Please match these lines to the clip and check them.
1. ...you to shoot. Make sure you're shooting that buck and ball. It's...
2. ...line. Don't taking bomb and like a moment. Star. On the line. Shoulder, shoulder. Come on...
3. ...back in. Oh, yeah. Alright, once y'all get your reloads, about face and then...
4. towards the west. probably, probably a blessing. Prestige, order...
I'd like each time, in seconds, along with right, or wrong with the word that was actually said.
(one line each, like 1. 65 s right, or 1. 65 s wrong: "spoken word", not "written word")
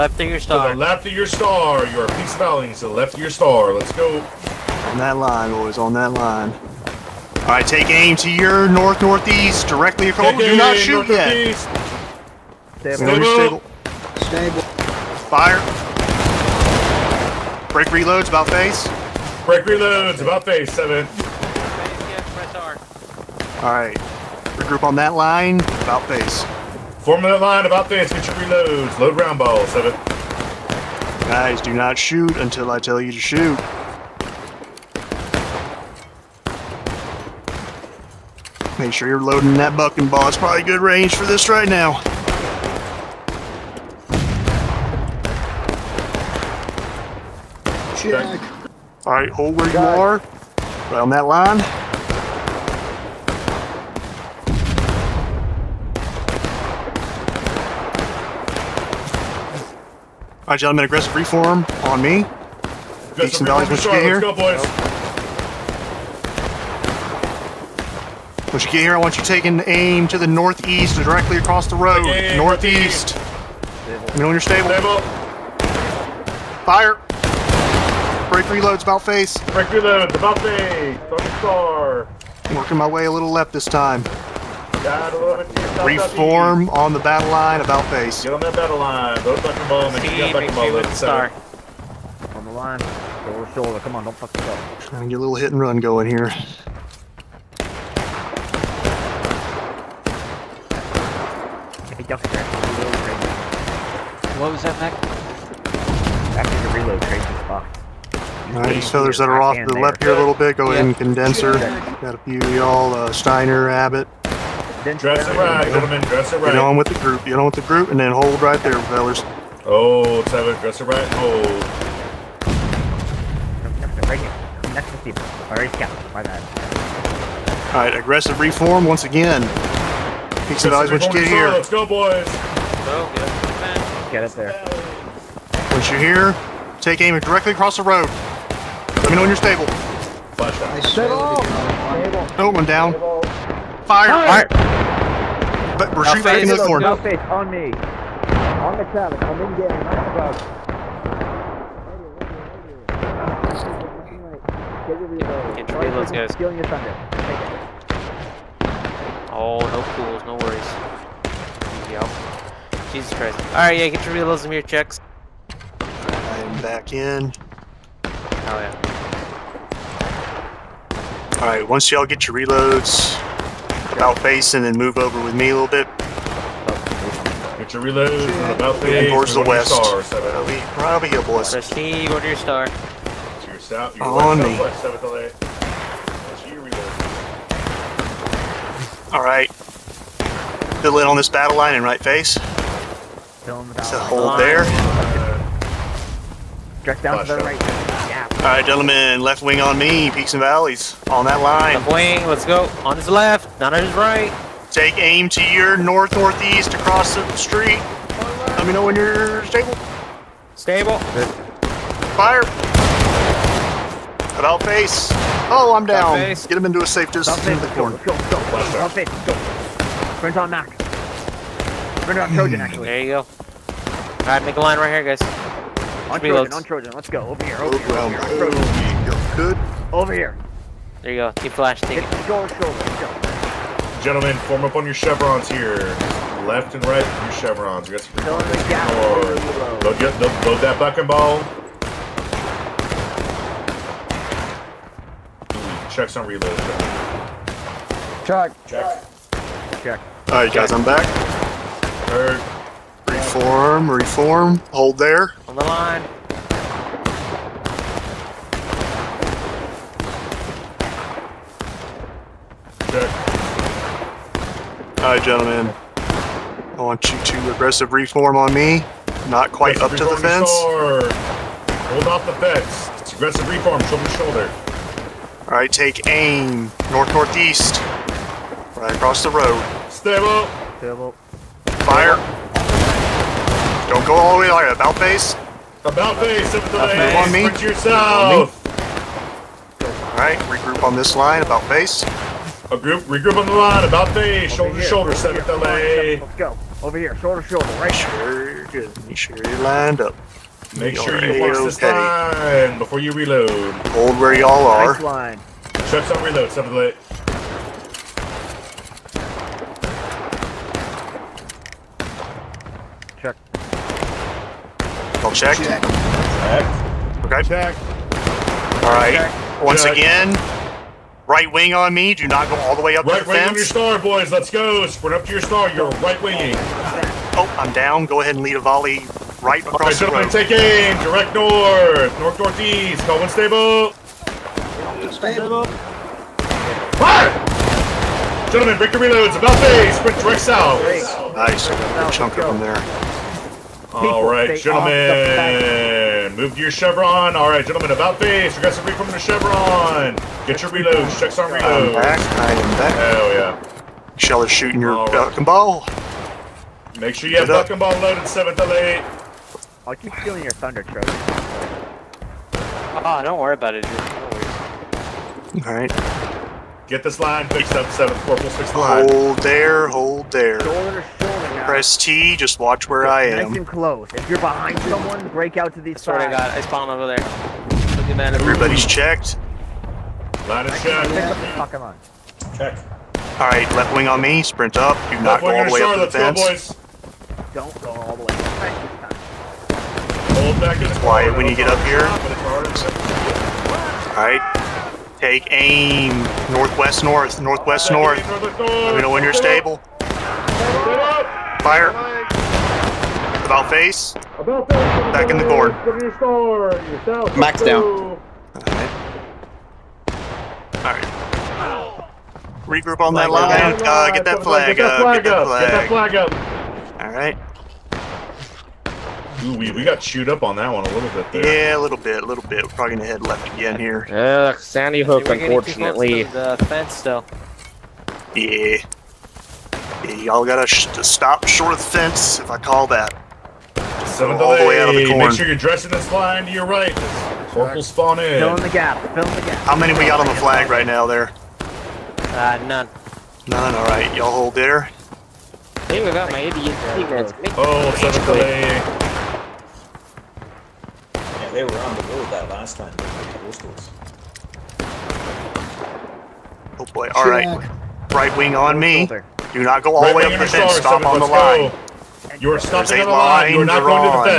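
1. 32 s wrong: "loading", not "shooting"
2. 88 s wrong: "fucking", not "taking"
3. 166 s right
4. 179 s right.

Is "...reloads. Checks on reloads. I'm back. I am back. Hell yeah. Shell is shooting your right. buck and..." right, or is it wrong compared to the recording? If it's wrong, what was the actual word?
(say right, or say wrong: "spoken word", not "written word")
right.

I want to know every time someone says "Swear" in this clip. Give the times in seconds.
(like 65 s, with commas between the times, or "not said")
376 s.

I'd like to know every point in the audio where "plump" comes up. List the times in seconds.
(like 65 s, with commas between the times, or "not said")
not said.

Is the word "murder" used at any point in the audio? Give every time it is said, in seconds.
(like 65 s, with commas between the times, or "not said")
not said.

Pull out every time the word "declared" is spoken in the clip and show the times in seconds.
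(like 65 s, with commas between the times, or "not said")
not said.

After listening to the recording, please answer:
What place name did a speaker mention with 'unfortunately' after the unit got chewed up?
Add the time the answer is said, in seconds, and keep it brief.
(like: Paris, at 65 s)
Sandy Hook, at 424 s.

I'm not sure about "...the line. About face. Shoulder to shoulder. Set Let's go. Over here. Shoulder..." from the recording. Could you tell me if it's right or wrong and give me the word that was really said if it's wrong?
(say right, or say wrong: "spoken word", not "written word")
right.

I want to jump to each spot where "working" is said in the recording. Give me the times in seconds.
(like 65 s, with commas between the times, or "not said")
82 s.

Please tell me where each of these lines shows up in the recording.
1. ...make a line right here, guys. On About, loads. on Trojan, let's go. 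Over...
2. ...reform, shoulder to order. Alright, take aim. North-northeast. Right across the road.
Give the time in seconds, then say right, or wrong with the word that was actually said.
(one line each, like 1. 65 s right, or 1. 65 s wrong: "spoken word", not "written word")
1. 224 s wrong: "Trojan", not "About"
2. 273 s wrong: "shoulder", not "order".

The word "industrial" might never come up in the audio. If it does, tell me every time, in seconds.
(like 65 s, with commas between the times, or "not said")
102 s.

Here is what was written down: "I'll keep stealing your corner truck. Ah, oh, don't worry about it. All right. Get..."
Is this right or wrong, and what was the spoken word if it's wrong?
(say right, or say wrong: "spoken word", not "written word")
wrong: "thunder", not "corner".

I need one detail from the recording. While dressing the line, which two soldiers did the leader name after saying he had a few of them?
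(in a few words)
Steiner, Abbott.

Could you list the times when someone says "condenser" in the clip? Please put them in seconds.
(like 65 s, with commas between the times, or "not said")
110 s.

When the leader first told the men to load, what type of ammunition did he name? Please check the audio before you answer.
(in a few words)
round ball.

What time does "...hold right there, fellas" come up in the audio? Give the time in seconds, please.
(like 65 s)
118 s.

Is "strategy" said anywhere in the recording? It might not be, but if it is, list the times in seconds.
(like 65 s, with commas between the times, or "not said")
not said.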